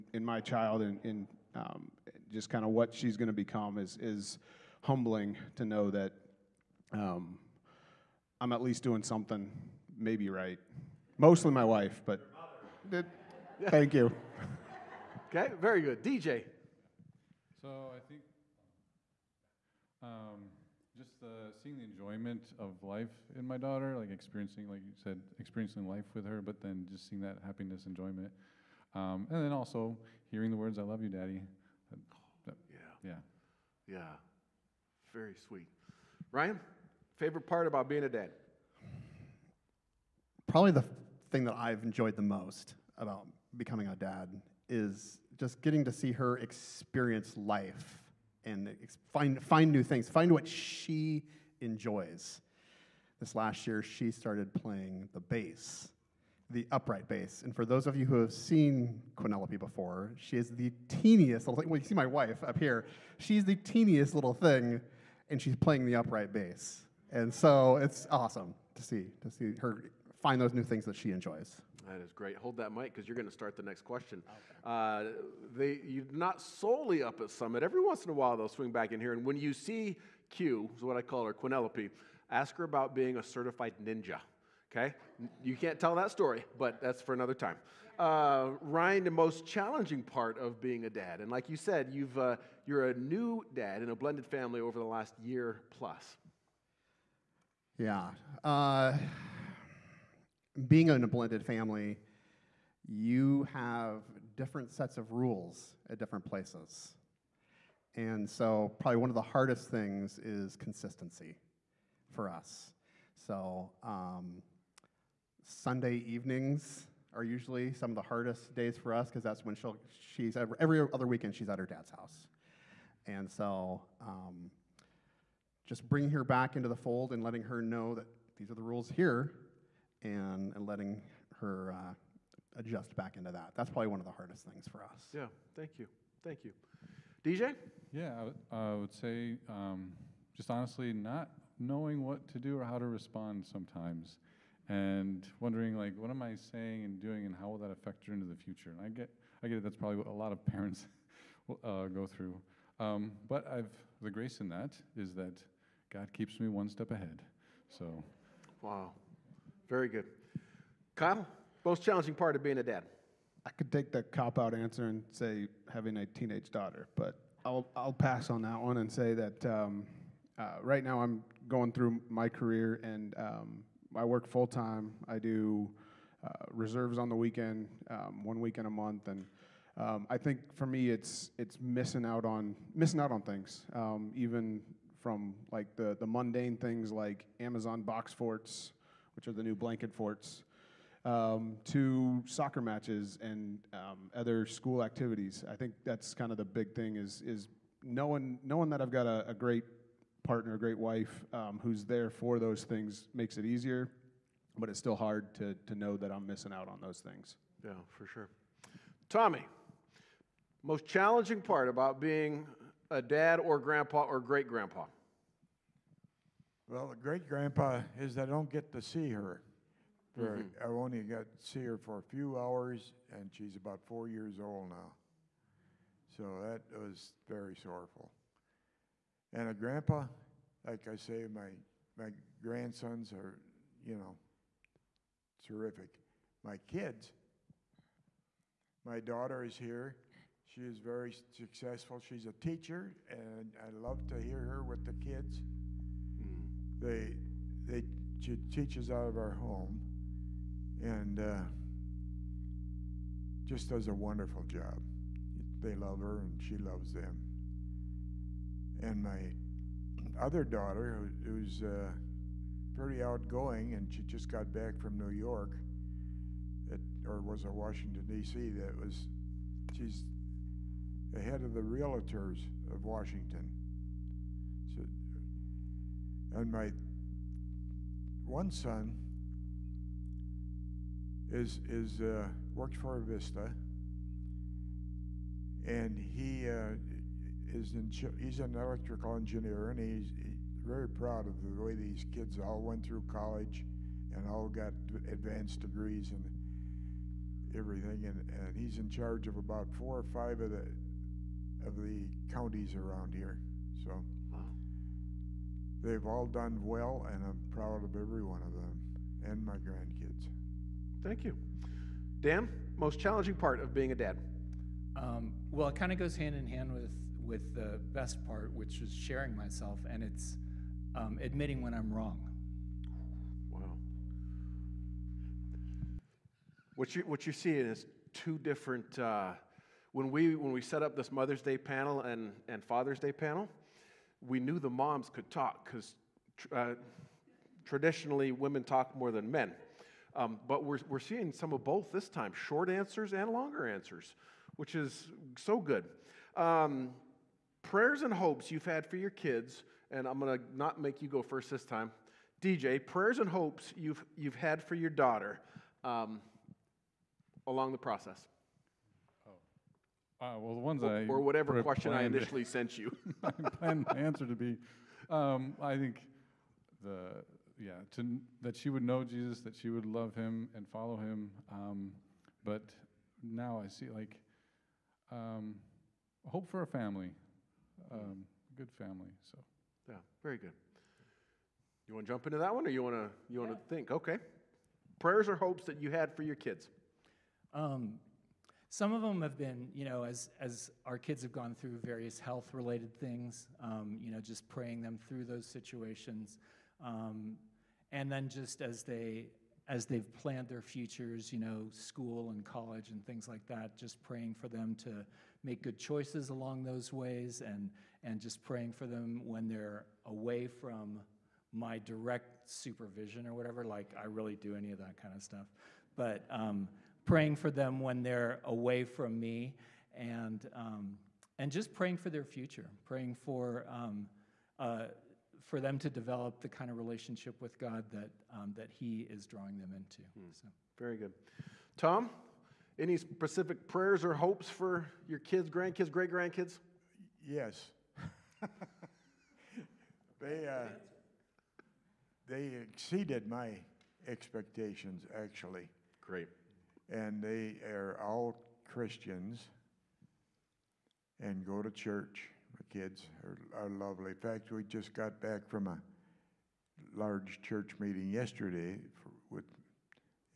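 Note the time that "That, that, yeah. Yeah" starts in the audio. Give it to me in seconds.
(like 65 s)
31 s.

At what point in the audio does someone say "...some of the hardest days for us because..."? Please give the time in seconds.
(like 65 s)
117 s.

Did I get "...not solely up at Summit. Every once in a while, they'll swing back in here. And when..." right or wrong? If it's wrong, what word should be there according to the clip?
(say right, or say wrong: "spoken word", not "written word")
right.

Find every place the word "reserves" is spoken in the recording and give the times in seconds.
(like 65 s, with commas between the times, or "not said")
176 s.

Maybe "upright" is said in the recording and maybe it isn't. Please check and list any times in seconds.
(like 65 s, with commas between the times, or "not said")
56 s, 65 s.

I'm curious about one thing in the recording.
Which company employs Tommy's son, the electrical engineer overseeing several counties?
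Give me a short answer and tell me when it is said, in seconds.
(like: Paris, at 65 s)
Avista, at 283 s.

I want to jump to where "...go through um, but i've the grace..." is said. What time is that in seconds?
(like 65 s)
151 s.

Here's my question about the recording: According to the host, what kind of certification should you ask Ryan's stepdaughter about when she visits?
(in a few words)
Certified ninja.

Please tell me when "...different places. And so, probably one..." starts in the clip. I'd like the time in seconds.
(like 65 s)
105 s.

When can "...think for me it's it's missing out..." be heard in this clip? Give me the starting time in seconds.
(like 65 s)
180 s.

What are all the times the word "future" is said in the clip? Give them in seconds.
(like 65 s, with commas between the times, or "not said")
148 s, 400 s, 422 s.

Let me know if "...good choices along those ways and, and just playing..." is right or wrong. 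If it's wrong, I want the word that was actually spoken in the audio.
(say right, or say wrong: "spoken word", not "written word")
wrong: "praying", not "playing".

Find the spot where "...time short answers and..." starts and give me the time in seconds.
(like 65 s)
342 s.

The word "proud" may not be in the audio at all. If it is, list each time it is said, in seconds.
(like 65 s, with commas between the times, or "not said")
290 s, 307 s.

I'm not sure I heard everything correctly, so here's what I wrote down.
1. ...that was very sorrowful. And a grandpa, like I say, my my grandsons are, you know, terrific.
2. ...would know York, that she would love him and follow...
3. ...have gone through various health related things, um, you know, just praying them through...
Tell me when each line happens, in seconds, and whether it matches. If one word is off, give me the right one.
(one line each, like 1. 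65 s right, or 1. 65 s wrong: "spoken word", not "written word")
1. 226 s right
2. 368 s wrong: "Jesus", not "York"
3. 391 s right.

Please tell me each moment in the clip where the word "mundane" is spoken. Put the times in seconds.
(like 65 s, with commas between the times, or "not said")
186 s.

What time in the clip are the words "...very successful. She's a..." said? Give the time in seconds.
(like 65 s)
240 s.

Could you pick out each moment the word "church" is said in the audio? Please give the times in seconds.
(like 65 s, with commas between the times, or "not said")
451 s, 457 s.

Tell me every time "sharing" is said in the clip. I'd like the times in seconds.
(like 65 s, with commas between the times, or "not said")
318 s.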